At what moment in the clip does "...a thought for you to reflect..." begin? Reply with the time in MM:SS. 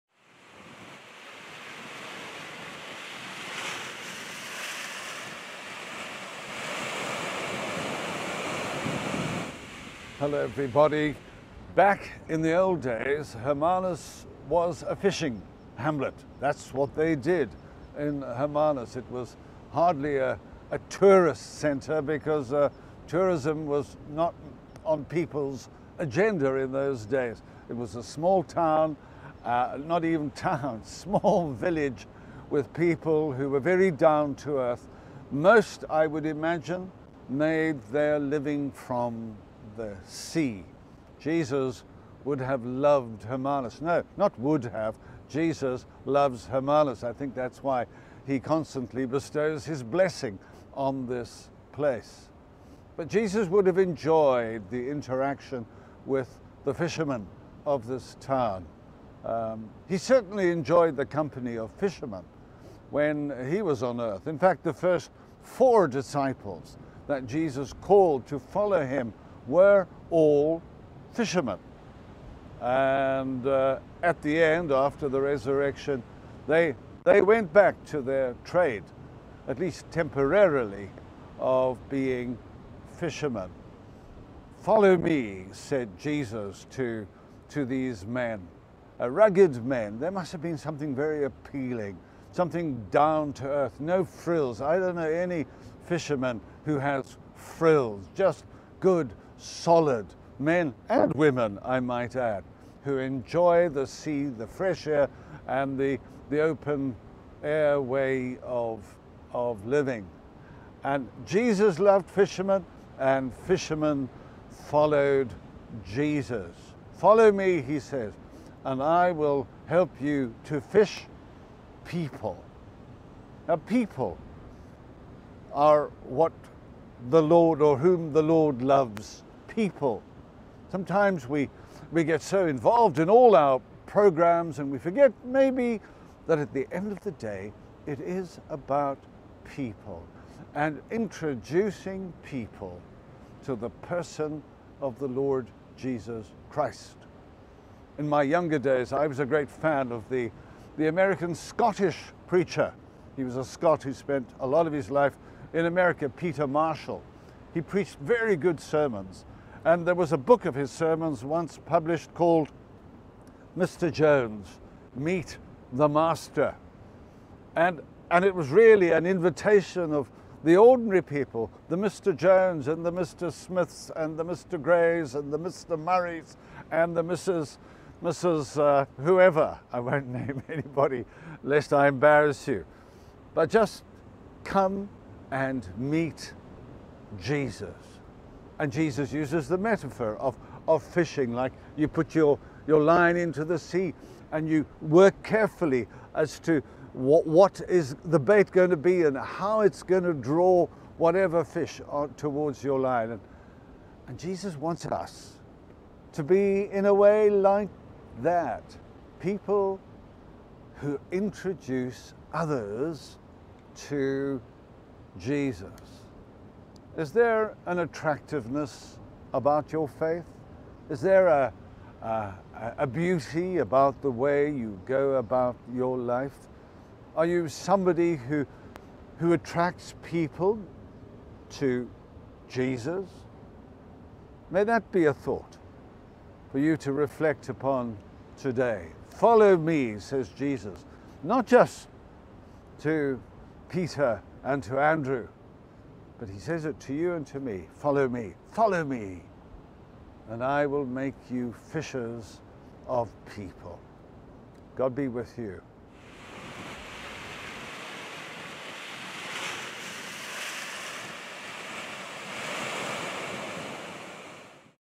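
03:55.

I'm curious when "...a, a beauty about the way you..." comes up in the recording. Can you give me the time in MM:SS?
03:42.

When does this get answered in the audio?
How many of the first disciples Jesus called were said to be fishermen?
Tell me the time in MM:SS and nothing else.
01:05.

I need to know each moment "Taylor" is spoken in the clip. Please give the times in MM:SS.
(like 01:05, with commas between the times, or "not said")
not said.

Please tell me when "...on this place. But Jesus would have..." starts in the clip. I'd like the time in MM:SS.
00:50.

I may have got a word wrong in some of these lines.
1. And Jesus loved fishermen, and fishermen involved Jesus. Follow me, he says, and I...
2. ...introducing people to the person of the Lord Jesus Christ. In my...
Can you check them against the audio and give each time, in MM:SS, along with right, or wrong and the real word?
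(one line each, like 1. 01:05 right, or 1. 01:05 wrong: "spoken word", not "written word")
1. 01:50 wrong: "followed", not "involved"
2. 02:20 right.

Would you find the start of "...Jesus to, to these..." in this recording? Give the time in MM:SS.
01:25.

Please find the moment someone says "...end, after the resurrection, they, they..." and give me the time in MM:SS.
01:14.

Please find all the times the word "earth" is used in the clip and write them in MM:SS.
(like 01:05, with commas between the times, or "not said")
00:34, 01:04, 01:33.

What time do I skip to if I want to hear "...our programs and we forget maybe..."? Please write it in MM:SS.
02:13.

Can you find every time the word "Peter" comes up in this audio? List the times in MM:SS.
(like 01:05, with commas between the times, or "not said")
02:36, 04:03.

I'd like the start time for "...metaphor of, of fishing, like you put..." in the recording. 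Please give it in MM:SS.
03:09.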